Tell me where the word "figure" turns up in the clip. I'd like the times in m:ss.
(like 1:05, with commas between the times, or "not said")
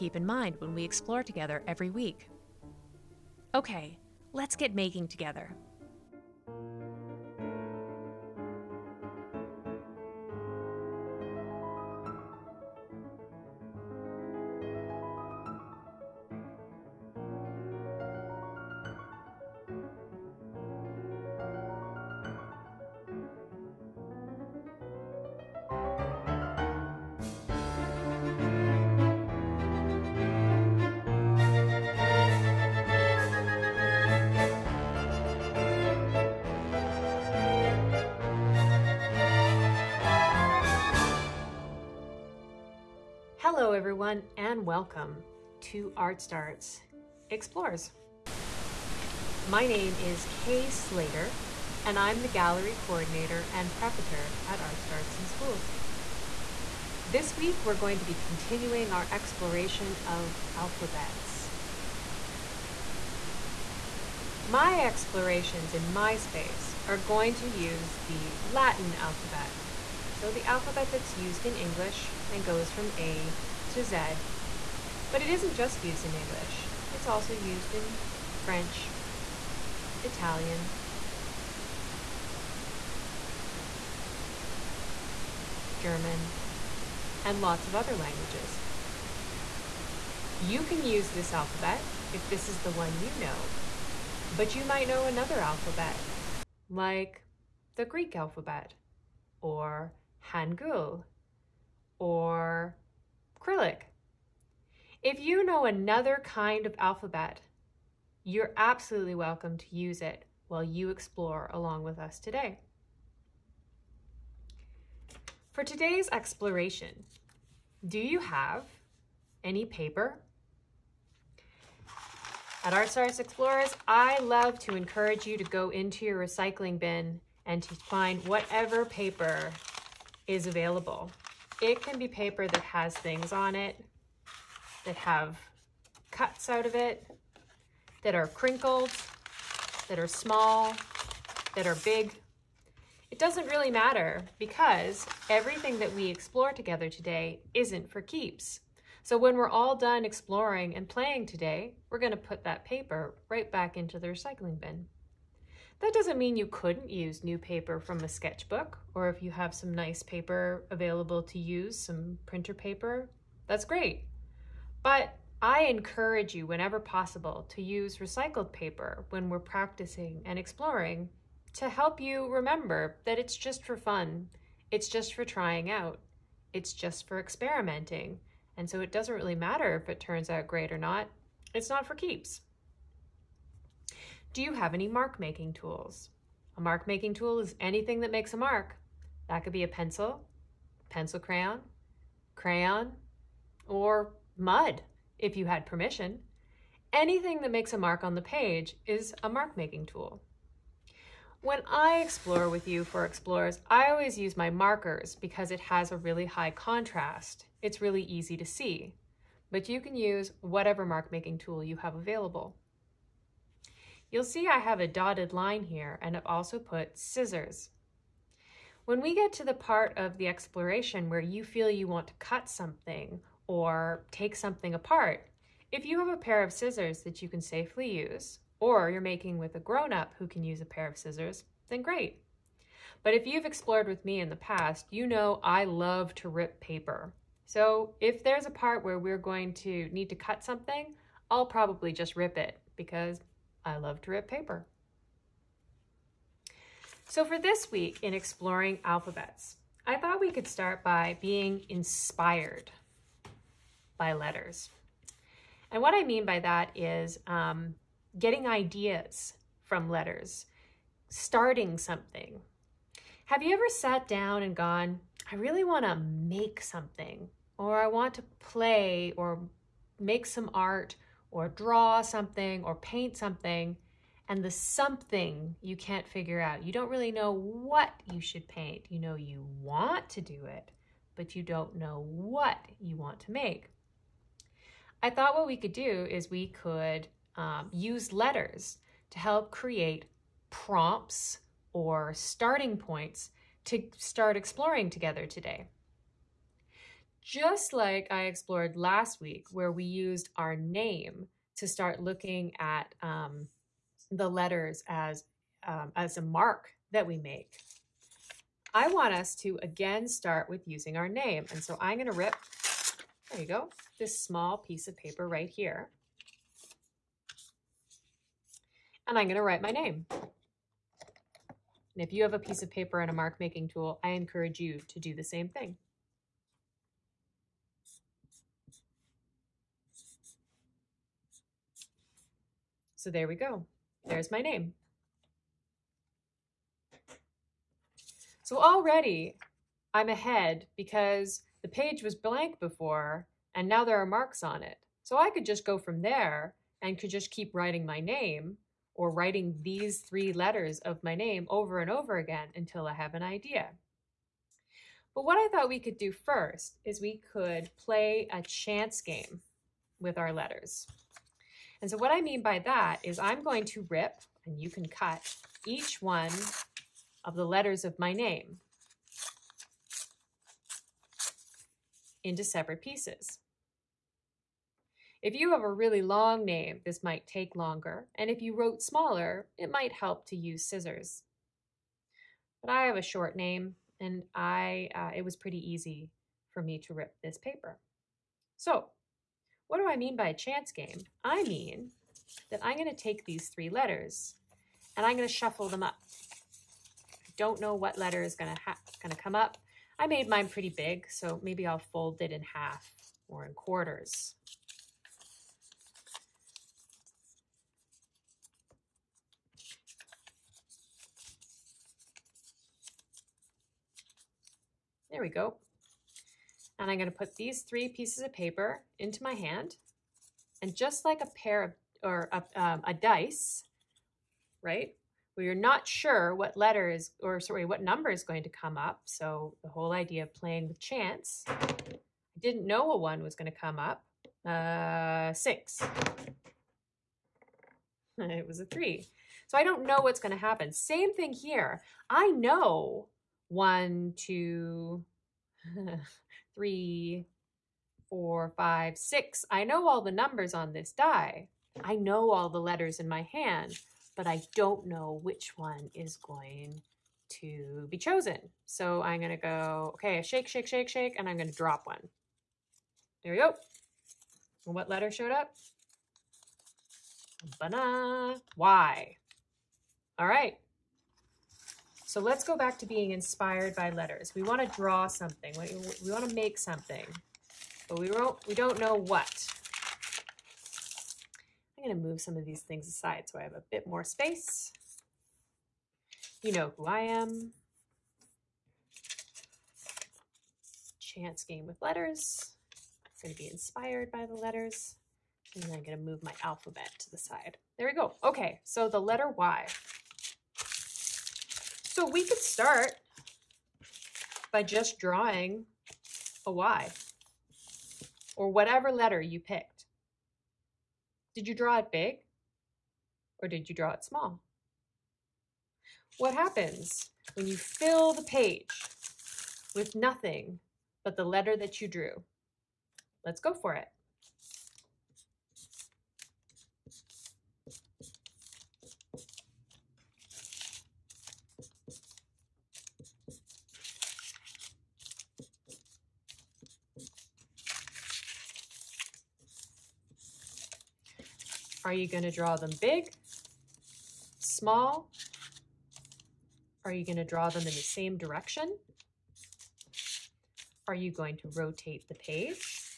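4:36.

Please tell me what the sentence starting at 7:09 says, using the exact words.
So the whole idea of playing with chance, I didn't know a one was going to come up.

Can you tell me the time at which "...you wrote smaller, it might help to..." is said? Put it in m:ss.
6:18.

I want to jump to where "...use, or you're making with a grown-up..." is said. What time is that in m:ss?
3:47.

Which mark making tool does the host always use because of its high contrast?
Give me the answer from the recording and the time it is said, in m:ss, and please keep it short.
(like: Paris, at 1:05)
Markers, at 3:24.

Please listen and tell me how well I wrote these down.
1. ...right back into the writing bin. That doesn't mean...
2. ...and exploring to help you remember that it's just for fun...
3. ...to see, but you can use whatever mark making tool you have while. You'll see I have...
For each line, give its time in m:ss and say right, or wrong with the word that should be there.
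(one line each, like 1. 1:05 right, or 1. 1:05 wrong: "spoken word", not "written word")
1. 2:33 wrong: "recycling", not "writing"
2. 2:50 right
3. 3:28 wrong: "available", not "while".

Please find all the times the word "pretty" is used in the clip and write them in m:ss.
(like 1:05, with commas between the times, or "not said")
6:25, 6:40.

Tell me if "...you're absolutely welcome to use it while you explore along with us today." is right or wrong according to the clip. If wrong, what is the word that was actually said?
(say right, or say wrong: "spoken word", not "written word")
right.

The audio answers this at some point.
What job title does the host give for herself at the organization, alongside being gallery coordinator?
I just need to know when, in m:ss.
0:53.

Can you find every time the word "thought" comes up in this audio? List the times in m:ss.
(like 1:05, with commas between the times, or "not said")
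4:09, 4:45, 5:55.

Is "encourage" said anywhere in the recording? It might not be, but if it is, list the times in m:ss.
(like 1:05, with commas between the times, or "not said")
2:04, 2:45, 5:24.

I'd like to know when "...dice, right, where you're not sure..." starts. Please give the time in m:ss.
7:02.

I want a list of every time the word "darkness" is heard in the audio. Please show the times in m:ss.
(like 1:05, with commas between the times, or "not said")
not said.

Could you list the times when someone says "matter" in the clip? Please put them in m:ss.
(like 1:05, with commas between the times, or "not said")
2:23, 2:59.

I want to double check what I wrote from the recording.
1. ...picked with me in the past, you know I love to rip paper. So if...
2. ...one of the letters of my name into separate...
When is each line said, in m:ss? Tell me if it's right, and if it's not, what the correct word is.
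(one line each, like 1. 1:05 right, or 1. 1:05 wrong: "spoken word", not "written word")
1. 3:53 wrong: "explored", not "picked"
2. 6:06 right.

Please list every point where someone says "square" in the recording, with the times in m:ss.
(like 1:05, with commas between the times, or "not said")
not said.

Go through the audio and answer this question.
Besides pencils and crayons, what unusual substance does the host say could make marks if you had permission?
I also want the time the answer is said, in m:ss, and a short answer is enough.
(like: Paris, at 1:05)
Mud, at 3:14.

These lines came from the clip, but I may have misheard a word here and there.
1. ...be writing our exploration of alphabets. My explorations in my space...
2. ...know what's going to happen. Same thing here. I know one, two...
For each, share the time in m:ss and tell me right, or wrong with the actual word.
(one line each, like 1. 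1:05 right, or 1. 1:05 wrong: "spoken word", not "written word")
1. 0:58 wrong: "continuing", not "writing"
2. 7:19 right.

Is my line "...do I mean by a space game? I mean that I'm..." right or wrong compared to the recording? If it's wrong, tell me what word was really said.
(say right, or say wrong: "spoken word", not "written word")
wrong: "chance", not "space".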